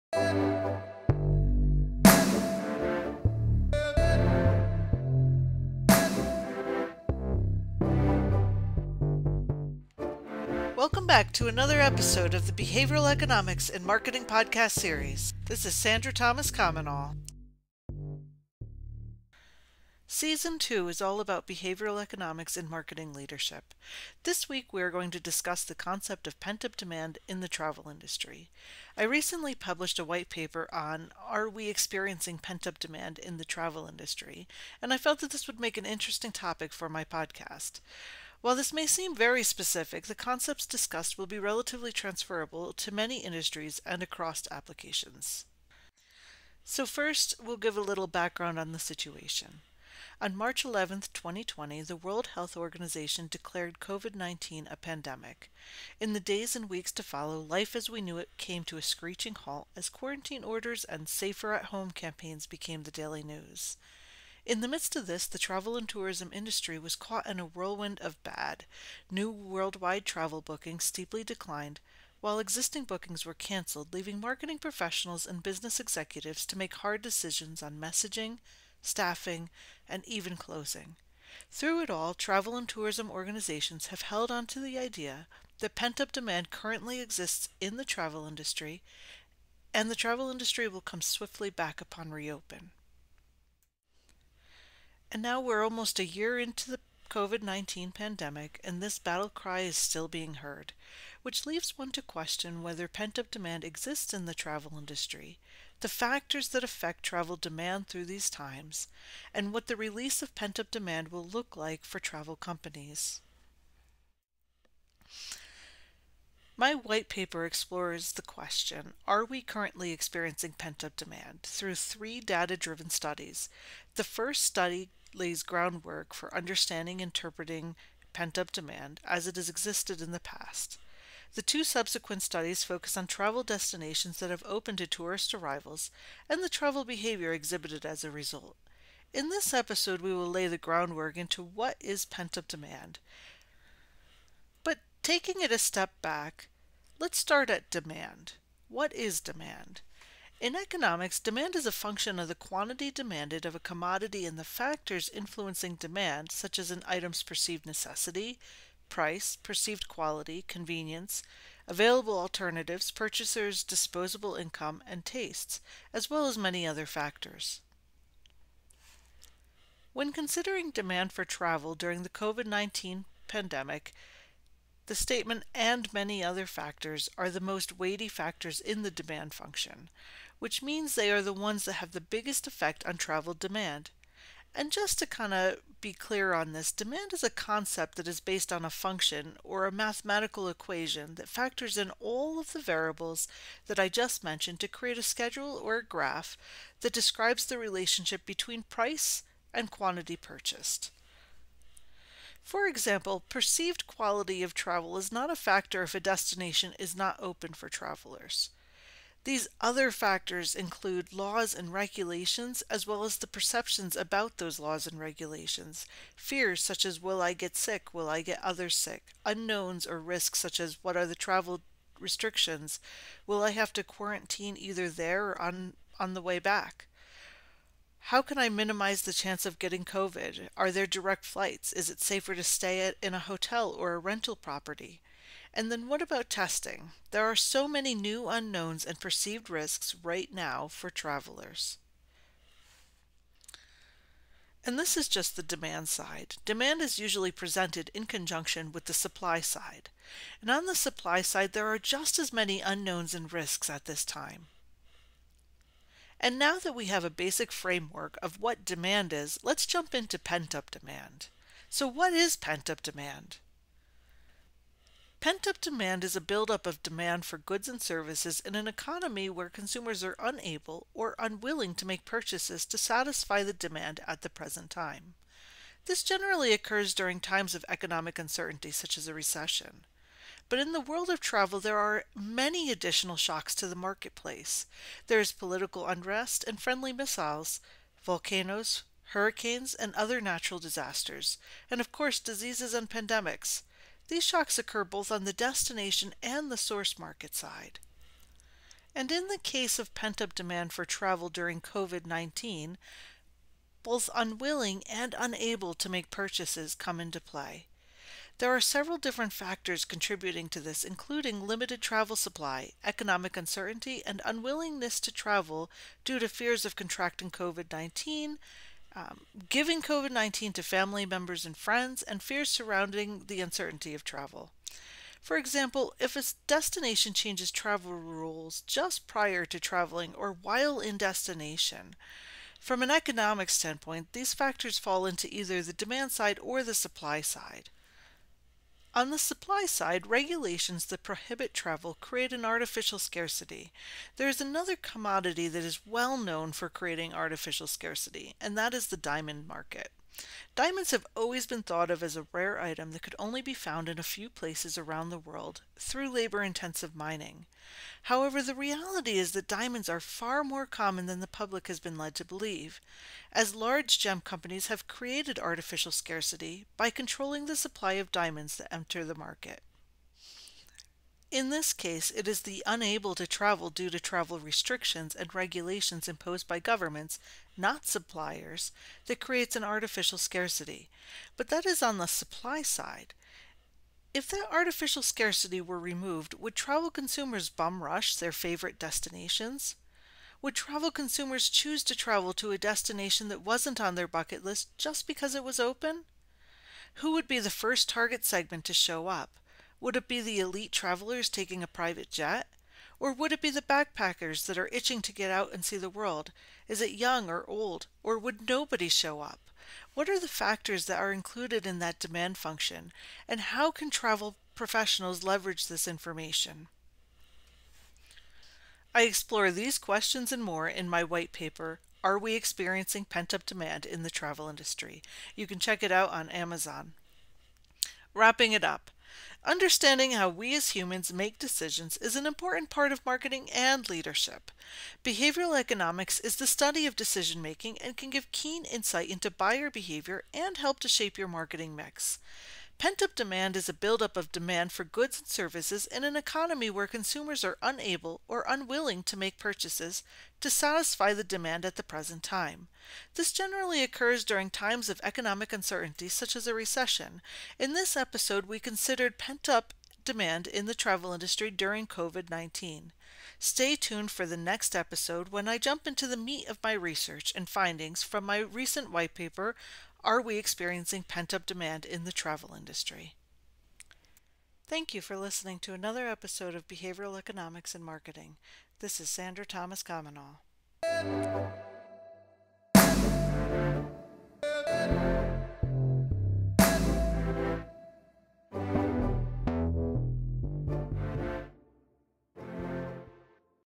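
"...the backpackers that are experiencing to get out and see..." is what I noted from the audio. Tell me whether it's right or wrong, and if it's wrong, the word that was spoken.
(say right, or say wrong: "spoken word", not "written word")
wrong: "itching", not "experiencing".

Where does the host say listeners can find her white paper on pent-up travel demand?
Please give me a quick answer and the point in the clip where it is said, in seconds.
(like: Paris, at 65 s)
Amazon, at 426 s.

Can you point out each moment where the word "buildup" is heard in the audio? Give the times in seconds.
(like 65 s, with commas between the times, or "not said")
266 s, 443 s.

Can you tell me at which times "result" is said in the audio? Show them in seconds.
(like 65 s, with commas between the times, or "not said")
138 s.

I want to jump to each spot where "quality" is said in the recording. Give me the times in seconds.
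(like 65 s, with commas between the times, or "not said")
159 s, 203 s.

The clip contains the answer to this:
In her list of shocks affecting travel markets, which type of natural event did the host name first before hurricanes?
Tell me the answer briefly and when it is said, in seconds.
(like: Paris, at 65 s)
Volcanoes, at 288 s.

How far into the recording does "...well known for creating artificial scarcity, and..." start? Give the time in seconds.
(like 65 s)
345 s.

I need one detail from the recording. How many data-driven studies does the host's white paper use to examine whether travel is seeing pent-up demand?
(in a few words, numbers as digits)
3.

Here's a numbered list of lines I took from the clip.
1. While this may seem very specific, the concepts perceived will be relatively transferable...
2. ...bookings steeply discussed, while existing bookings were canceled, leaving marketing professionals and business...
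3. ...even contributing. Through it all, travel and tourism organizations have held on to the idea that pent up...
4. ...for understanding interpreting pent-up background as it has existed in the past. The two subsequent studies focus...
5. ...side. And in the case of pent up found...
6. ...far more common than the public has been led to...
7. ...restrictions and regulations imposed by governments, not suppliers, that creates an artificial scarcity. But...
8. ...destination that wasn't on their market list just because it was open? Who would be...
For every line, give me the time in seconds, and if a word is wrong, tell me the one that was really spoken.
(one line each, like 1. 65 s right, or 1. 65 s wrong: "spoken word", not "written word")
1. 38 s wrong: "discussed", not "perceived"
2. 70 s wrong: "declined", not "discussed"
3. 80 s wrong: "closing", not "contributing"
4. 126 s wrong: "demand", not "background"
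5. 297 s wrong: "demand", not "found"
6. 360 s right
7. 374 s right
8. 392 s wrong: "bucket", not "market".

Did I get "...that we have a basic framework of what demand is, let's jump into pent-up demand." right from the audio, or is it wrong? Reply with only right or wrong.
right.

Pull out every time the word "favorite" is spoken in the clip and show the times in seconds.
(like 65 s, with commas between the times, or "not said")
388 s.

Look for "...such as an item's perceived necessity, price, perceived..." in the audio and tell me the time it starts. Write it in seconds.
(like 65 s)
156 s.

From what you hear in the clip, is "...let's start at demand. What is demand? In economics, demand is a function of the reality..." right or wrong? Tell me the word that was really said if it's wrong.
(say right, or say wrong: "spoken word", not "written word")
wrong: "quantity", not "reality".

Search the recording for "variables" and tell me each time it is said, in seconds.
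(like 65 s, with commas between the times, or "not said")
192 s.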